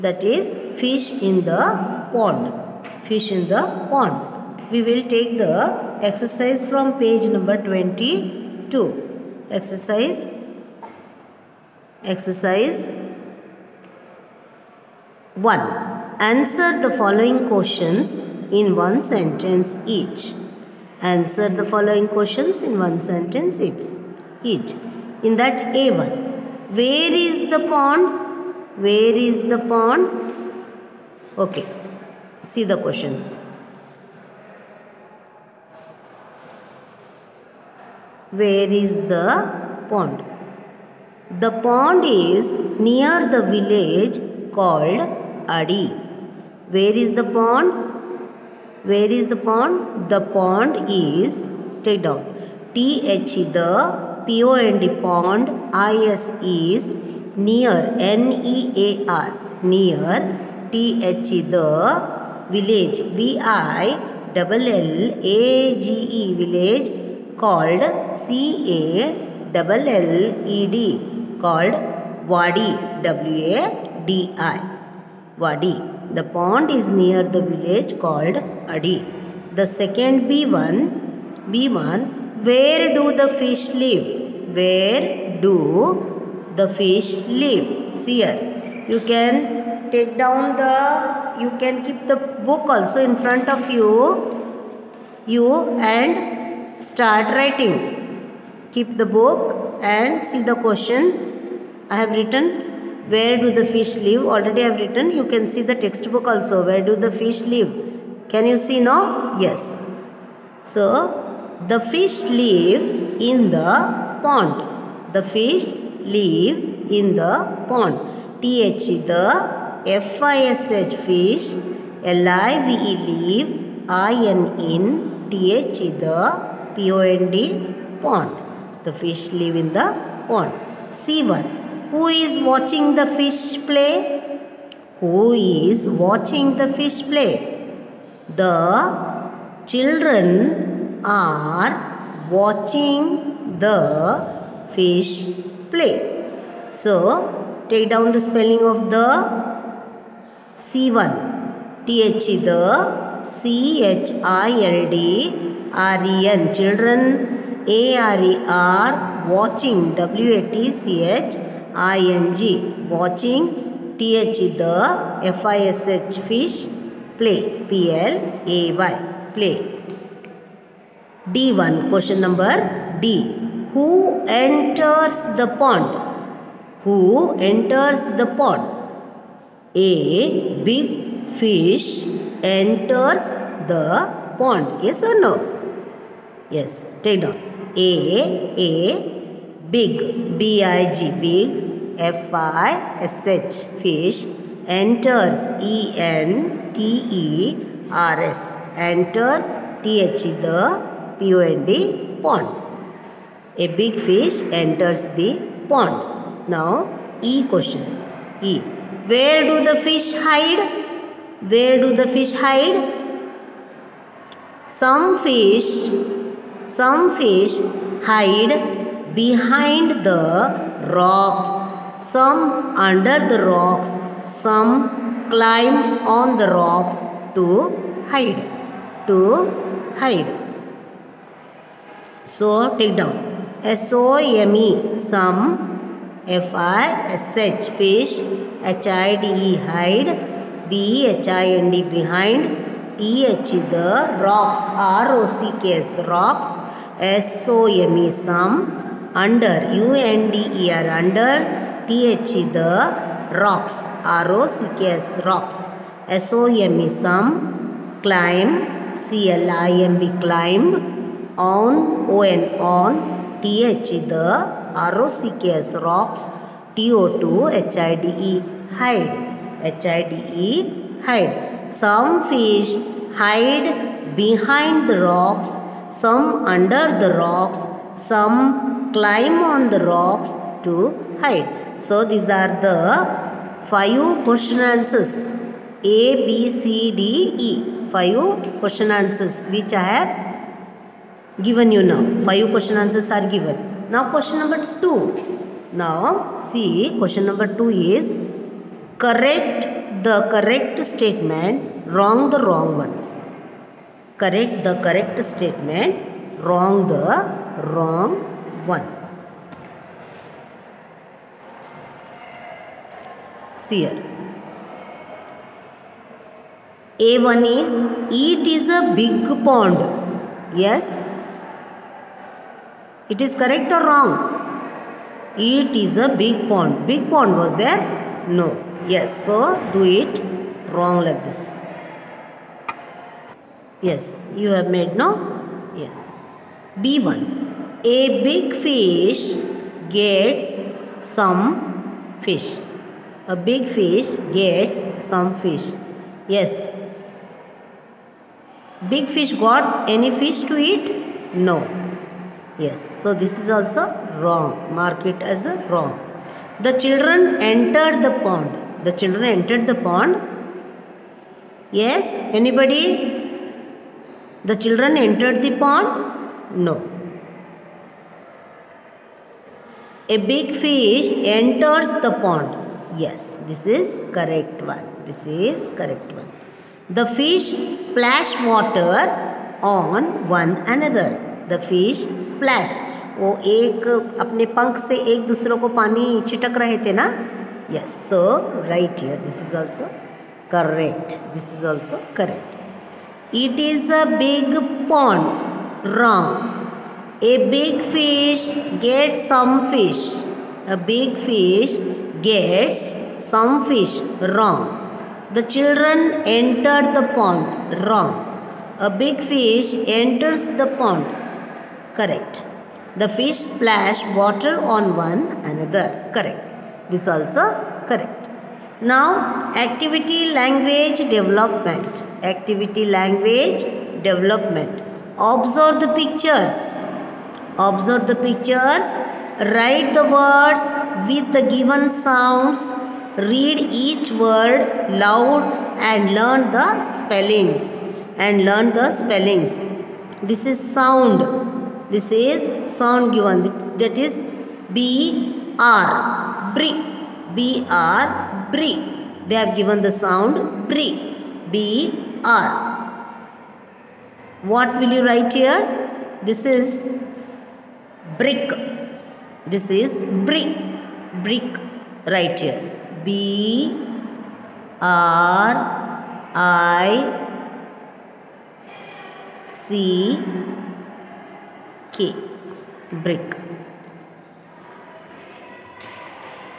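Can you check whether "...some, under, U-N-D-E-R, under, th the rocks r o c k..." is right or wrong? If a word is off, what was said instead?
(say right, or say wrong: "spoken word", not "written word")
right.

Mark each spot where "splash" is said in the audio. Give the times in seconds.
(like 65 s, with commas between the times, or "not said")
377 s, 382 s, 413 s.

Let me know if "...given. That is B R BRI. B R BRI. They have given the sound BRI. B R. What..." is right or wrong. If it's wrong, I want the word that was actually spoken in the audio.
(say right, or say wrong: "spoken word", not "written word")
right.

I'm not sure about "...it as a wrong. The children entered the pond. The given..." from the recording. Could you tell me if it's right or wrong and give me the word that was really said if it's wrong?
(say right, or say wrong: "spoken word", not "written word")
wrong: "children", not "given".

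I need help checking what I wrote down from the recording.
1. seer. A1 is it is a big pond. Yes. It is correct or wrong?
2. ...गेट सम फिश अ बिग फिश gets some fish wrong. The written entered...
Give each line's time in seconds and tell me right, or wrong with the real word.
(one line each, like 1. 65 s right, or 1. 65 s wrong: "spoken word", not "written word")
1. 313 s right
2. 398 s wrong: "children", not "written".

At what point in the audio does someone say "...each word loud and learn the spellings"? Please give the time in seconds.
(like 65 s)
433 s.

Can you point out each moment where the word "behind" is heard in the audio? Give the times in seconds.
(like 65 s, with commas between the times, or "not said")
219 s, 241 s, 274 s.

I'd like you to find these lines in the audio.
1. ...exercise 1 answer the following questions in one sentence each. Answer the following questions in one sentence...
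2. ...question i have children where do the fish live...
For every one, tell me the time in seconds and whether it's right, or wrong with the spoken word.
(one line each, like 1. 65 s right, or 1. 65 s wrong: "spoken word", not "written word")
1. 12 s right
2. 100 s wrong: "written", not "children".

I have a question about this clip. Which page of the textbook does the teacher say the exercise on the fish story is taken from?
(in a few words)
22.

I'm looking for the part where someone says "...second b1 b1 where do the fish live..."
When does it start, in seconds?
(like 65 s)
79 s.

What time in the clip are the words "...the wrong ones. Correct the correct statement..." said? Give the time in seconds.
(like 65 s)
302 s.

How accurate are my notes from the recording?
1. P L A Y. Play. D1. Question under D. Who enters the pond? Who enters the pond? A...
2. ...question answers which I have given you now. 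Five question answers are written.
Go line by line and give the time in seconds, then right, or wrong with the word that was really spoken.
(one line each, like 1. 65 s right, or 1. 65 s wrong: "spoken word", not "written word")
1. 167 s wrong: "number", not "under"
2. 288 s wrong: "given", not "written".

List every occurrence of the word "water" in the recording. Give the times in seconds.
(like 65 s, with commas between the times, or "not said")
378 s, 414 s.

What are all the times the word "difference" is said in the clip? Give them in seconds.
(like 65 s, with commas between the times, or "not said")
not said.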